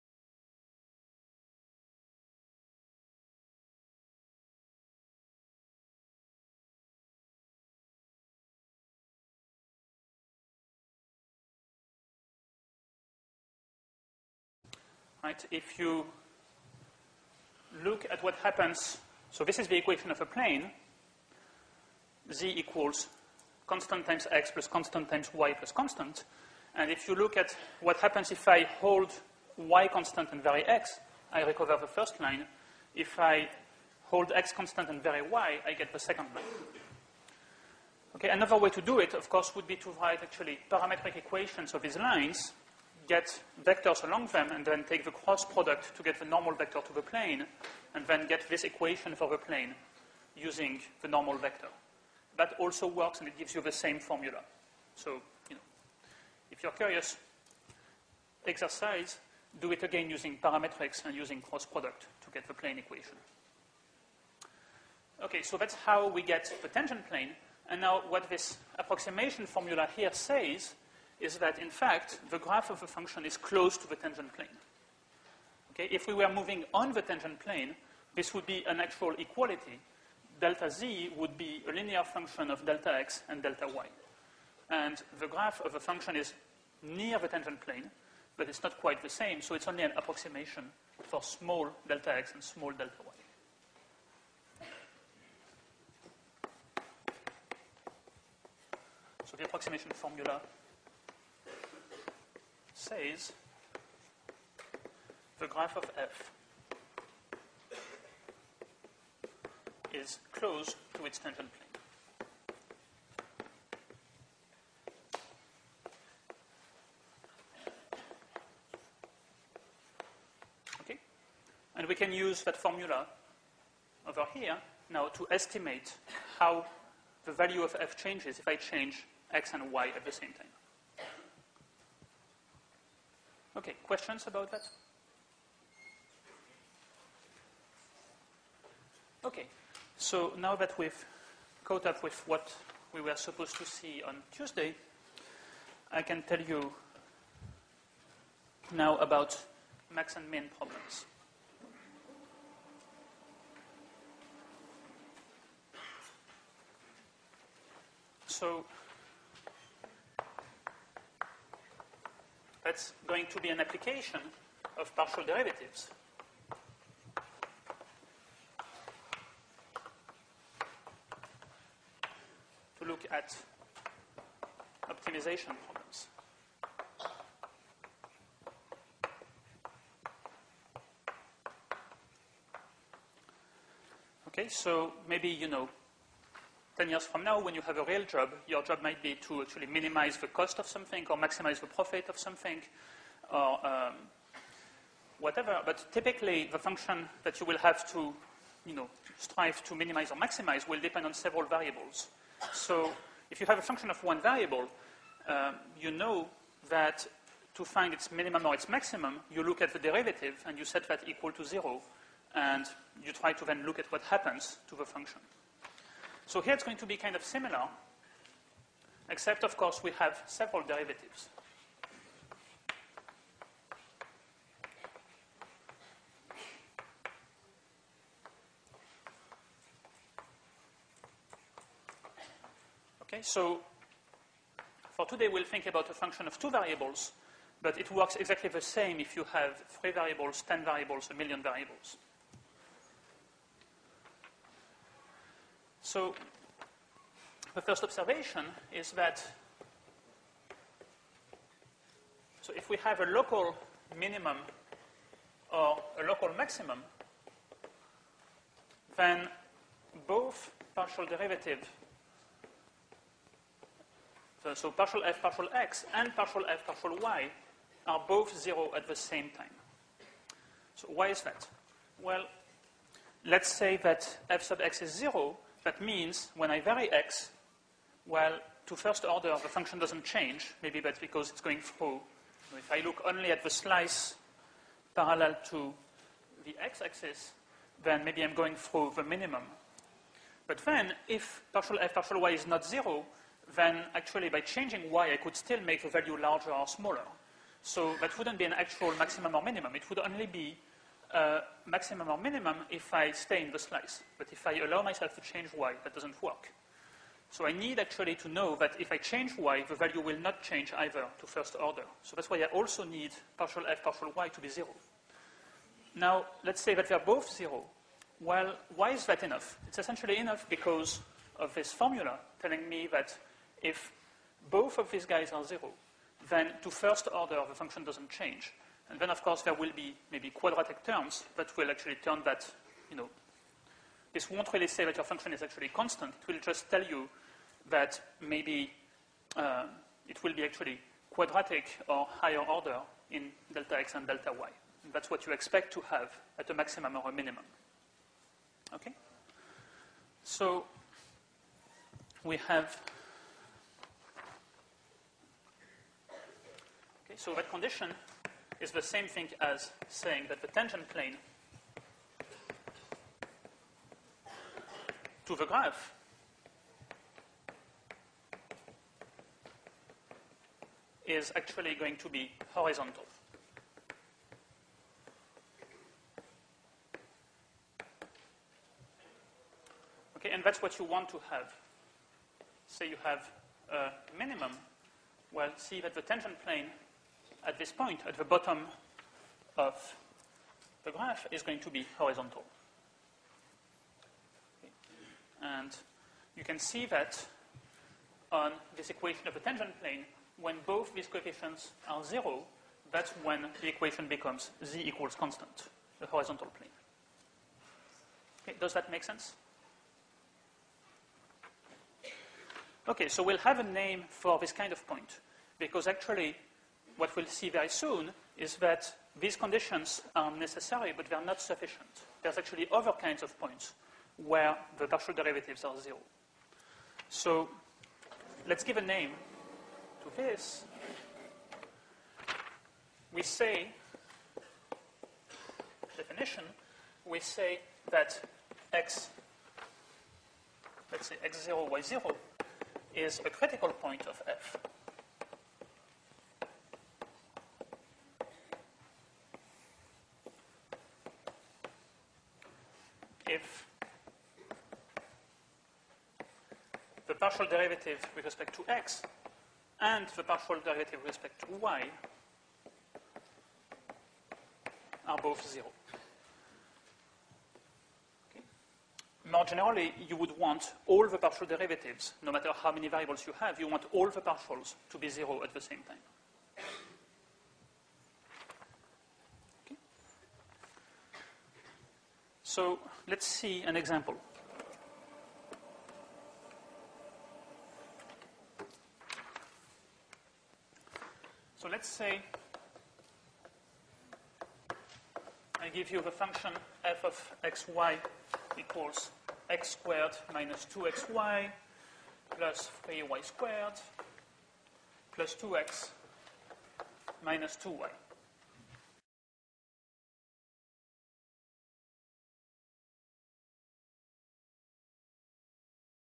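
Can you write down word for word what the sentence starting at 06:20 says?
Okay, and that's what you want to have.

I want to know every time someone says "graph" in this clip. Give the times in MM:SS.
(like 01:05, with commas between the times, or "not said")
01:12, 01:25, 01:45, 06:05, 06:30.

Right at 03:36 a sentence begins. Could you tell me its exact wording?
So here it's going to be kind of similar, except, of course, we have several derivatives.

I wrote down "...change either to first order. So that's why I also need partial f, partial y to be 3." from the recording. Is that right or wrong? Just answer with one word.
wrong.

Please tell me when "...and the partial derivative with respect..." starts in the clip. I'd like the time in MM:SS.
07:39.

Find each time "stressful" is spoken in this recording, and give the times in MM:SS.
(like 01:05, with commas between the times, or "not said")
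not said.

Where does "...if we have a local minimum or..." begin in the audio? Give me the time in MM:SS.
04:12.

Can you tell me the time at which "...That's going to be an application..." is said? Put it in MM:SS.
02:42.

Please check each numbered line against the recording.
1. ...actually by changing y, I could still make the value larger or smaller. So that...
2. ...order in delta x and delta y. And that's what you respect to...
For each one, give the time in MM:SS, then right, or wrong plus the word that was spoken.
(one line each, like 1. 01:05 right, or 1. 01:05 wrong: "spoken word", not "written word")
1. 04:53 right
2. 05:42 wrong: "expect", not "respect".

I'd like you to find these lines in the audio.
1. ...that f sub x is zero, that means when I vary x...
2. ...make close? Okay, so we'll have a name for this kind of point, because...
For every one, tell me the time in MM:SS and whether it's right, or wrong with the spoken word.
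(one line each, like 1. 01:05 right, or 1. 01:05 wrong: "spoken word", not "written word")
1. 04:33 right
2. 06:48 wrong: "sense", not "close".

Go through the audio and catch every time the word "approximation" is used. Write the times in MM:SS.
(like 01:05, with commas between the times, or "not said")
01:08, 01:29, 01:39.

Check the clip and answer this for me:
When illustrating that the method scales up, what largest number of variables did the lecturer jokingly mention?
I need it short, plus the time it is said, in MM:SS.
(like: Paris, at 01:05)
a million, at 04:01.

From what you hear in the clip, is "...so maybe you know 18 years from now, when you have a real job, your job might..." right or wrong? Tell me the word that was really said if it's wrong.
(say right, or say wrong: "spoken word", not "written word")
wrong: "10", not "18".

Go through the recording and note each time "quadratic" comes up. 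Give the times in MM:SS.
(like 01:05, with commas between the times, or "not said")
05:30, 05:41.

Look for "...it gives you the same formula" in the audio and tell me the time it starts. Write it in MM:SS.
00:53.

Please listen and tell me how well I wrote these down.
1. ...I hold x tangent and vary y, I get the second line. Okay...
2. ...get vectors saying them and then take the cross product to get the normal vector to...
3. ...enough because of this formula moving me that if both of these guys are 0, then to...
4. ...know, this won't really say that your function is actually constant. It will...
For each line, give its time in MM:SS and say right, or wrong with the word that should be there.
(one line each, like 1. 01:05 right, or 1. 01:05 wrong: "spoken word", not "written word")
1. 00:33 wrong: "constant", not "tangent"
2. 00:43 wrong: "along", not "saying"
3. 05:20 wrong: "telling", not "moving"
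4. 05:32 right.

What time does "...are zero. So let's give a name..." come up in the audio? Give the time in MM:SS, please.
07:05.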